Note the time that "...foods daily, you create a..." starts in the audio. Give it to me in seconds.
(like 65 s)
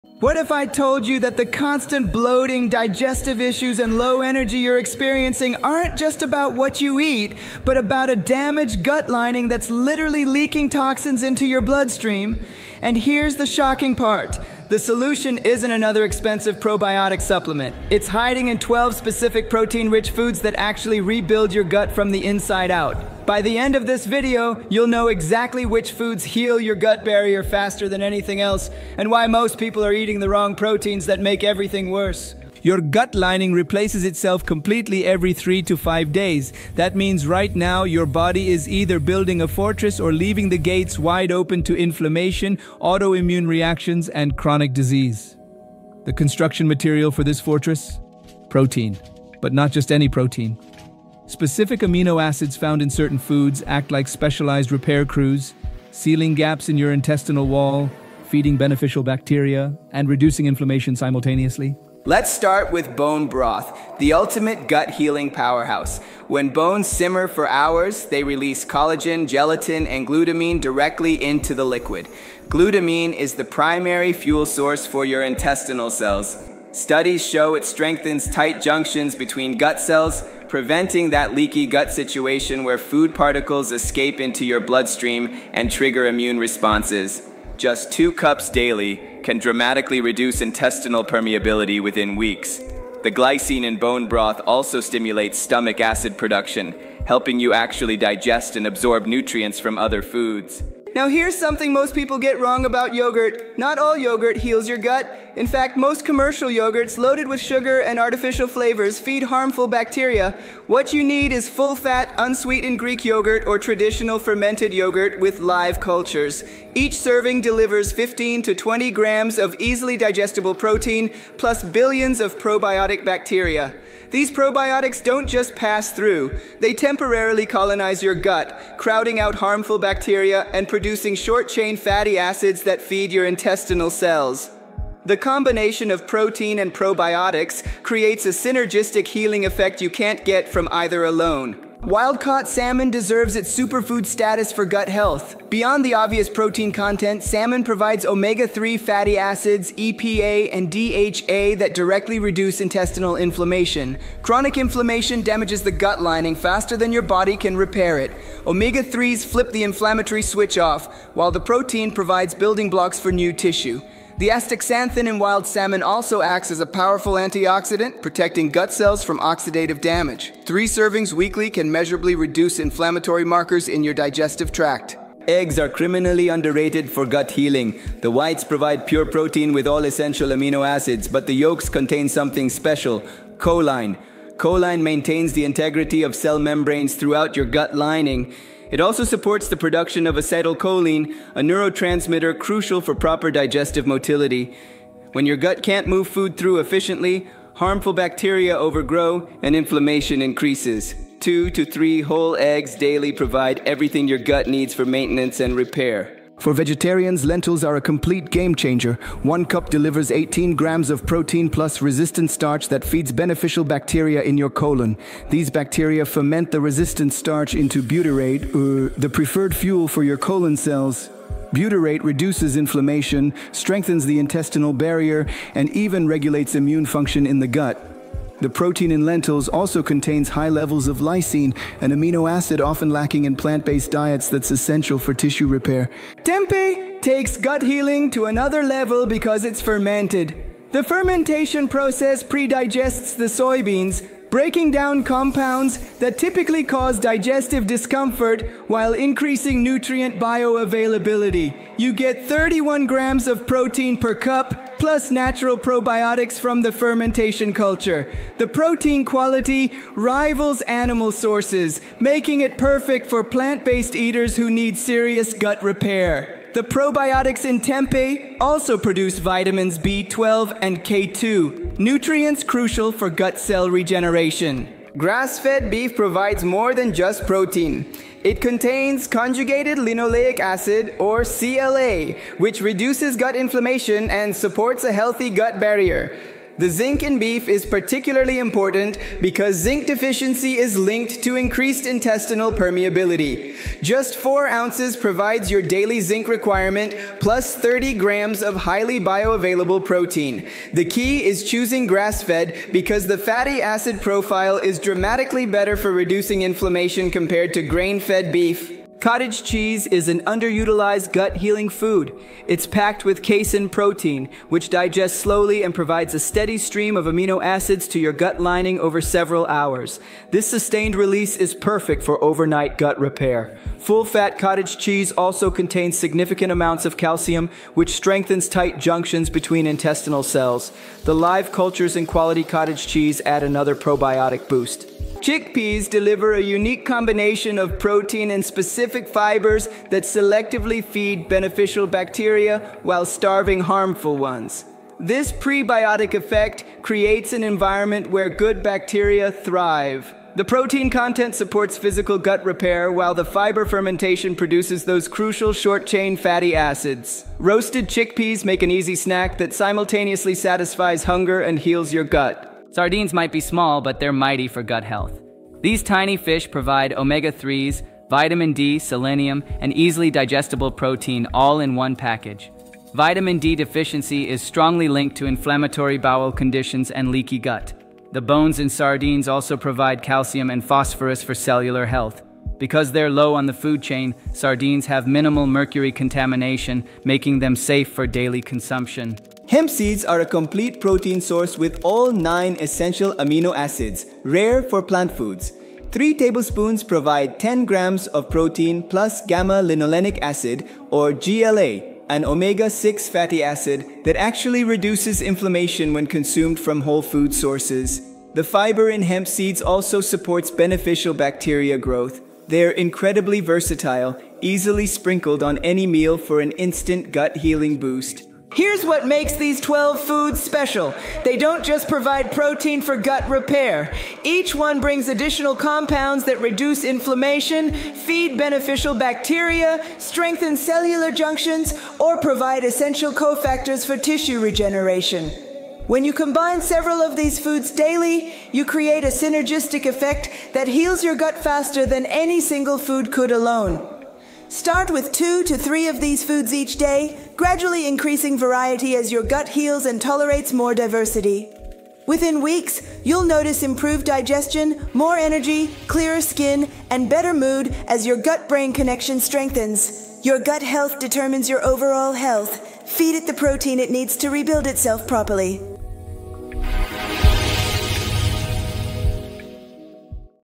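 437 s.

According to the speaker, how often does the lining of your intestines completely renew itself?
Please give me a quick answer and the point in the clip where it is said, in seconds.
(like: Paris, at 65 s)
3 to 5 days, at 35 s.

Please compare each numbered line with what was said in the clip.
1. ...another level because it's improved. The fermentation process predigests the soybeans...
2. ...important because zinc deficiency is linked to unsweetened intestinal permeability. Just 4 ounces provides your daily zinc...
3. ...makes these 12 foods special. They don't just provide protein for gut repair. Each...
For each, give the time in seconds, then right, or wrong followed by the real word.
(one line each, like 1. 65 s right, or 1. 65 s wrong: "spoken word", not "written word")
1. 238 s wrong: "fermented", not "improved"
2. 288 s wrong: "increased", not "unsweetened"
3. 419 s right.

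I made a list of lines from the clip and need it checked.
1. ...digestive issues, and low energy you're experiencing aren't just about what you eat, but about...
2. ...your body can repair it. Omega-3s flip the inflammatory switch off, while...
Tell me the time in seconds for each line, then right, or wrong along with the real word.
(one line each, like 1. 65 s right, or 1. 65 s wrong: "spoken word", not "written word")
1. 2 s right
2. 156 s right.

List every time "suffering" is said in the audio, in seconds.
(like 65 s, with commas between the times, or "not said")
not said.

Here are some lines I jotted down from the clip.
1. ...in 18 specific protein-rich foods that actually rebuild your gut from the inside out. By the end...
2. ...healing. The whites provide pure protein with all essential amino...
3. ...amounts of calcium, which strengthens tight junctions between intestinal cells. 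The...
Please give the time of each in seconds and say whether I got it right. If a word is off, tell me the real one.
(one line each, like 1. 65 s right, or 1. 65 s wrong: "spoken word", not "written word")
1. 18 s wrong: "12", not "18"
2. 177 s right
3. 326 s right.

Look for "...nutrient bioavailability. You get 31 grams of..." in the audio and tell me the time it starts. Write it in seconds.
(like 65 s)
249 s.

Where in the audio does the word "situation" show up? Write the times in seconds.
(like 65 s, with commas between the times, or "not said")
81 s.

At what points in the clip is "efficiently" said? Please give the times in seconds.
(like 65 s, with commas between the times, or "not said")
196 s.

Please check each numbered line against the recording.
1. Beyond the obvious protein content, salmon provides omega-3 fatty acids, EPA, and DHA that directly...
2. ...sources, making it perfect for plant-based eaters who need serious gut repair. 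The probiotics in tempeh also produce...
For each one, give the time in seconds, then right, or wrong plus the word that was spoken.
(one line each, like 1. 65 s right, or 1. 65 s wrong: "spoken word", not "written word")
1. 145 s right
2. 261 s right.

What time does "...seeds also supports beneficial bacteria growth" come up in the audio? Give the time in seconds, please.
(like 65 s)
409 s.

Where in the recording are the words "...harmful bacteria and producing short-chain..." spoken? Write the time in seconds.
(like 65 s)
129 s.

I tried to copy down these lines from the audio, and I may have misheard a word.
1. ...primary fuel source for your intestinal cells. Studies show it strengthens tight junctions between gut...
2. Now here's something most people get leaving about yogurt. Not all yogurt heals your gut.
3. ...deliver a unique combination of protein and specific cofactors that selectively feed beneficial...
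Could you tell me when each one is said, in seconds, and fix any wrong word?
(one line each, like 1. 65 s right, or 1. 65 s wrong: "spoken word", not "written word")
1. 73 s right
2. 100 s wrong: "wrong", not "leaving"
3. 335 s wrong: "fibers", not "cofactors".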